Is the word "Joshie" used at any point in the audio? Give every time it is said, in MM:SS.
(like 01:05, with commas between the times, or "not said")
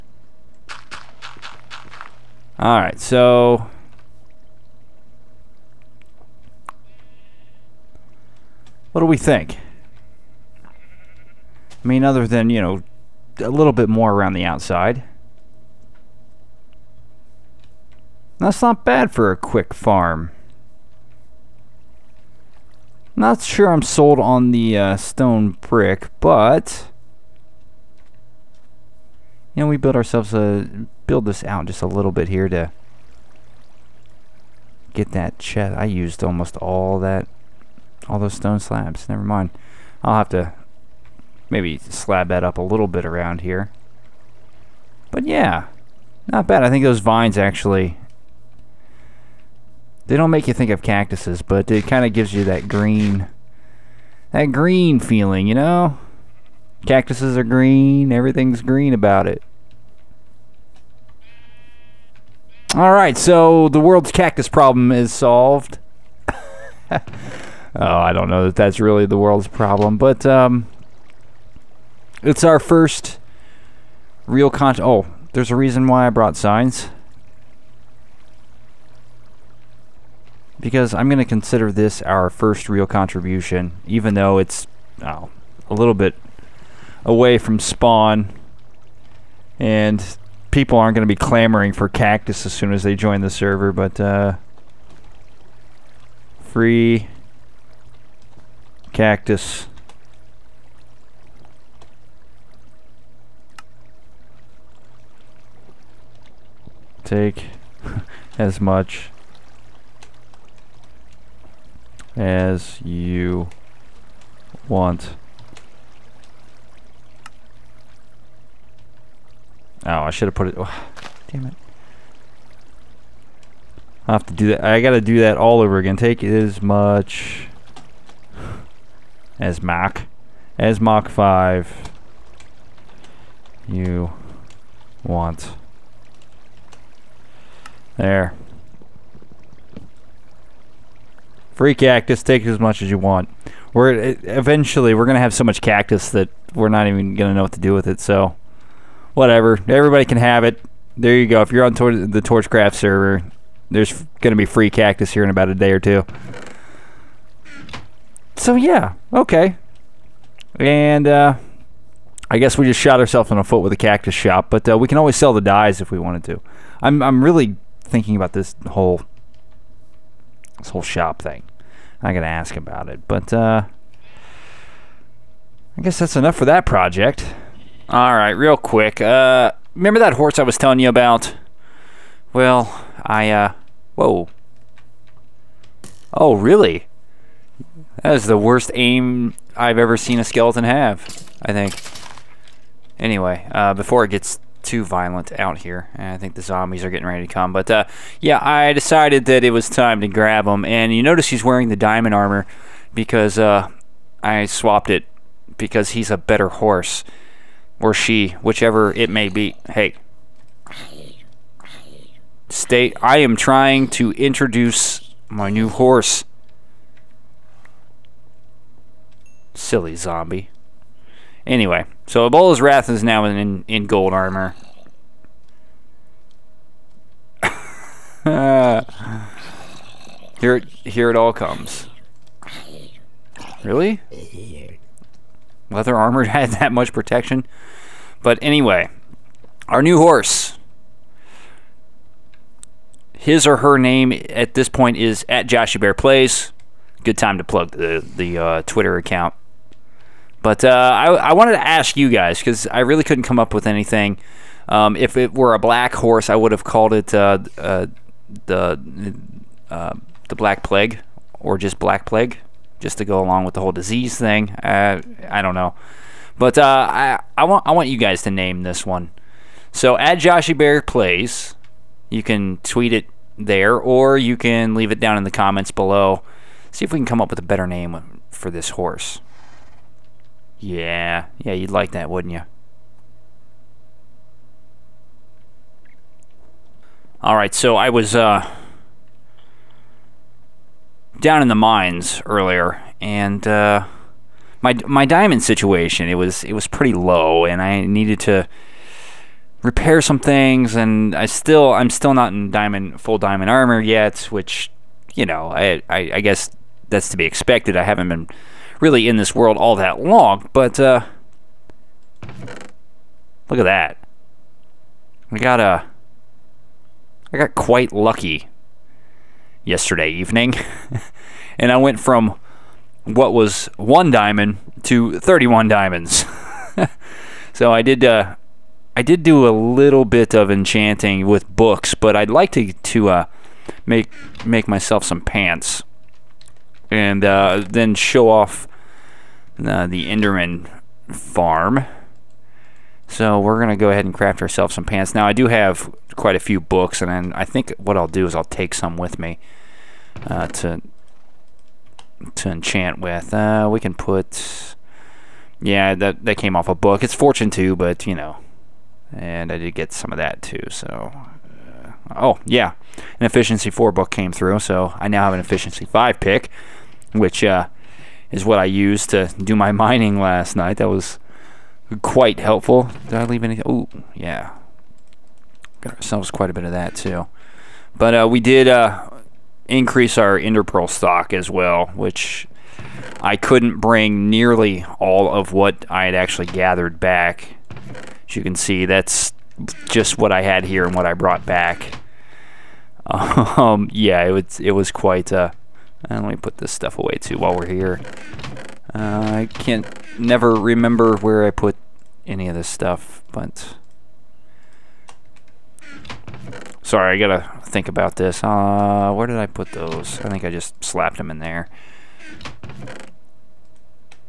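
04:05, 04:30.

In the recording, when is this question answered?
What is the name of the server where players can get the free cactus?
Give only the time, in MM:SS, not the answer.
02:32.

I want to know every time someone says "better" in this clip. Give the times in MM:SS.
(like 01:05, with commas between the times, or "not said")
03:26, 04:37.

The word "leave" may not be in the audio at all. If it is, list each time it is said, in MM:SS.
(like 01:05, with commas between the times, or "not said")
04:34, 06:13.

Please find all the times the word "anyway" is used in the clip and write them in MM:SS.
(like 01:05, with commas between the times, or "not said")
03:12, 03:41, 03:58.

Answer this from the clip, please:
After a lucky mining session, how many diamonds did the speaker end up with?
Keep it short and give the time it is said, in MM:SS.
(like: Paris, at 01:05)
31, at 05:25.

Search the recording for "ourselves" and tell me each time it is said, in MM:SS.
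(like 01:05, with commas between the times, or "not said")
00:29, 02:42, 05:44, 06:15.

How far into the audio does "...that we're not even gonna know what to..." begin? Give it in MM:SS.
02:26.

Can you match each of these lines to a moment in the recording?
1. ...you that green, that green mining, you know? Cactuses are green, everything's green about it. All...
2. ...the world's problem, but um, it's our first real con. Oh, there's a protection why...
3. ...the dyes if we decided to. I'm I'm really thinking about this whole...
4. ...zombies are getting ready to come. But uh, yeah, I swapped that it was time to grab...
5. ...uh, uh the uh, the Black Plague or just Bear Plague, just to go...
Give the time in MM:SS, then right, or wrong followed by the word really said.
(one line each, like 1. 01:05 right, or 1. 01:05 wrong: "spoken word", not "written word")
1. 00:52 wrong: "feeling", not "mining"
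2. 01:09 wrong: "reason", not "protection"
3. 02:45 wrong: "wanted", not "decided"
4. 03:16 wrong: "decided", not "swapped"
5. 04:17 wrong: "Black", not "Bear".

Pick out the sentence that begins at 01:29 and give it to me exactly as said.
And people aren't going to be clamoring for cactus as soon as they join the server, but uh, free cactus.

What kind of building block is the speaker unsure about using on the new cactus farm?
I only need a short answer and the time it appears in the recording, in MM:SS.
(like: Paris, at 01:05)
Stone brick, at 00:24.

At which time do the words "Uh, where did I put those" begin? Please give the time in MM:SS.
06:48.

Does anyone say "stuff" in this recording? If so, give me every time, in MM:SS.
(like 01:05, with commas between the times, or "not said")
06:36, 06:42.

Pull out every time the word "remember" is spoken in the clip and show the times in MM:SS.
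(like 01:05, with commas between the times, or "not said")
02:59, 06:40.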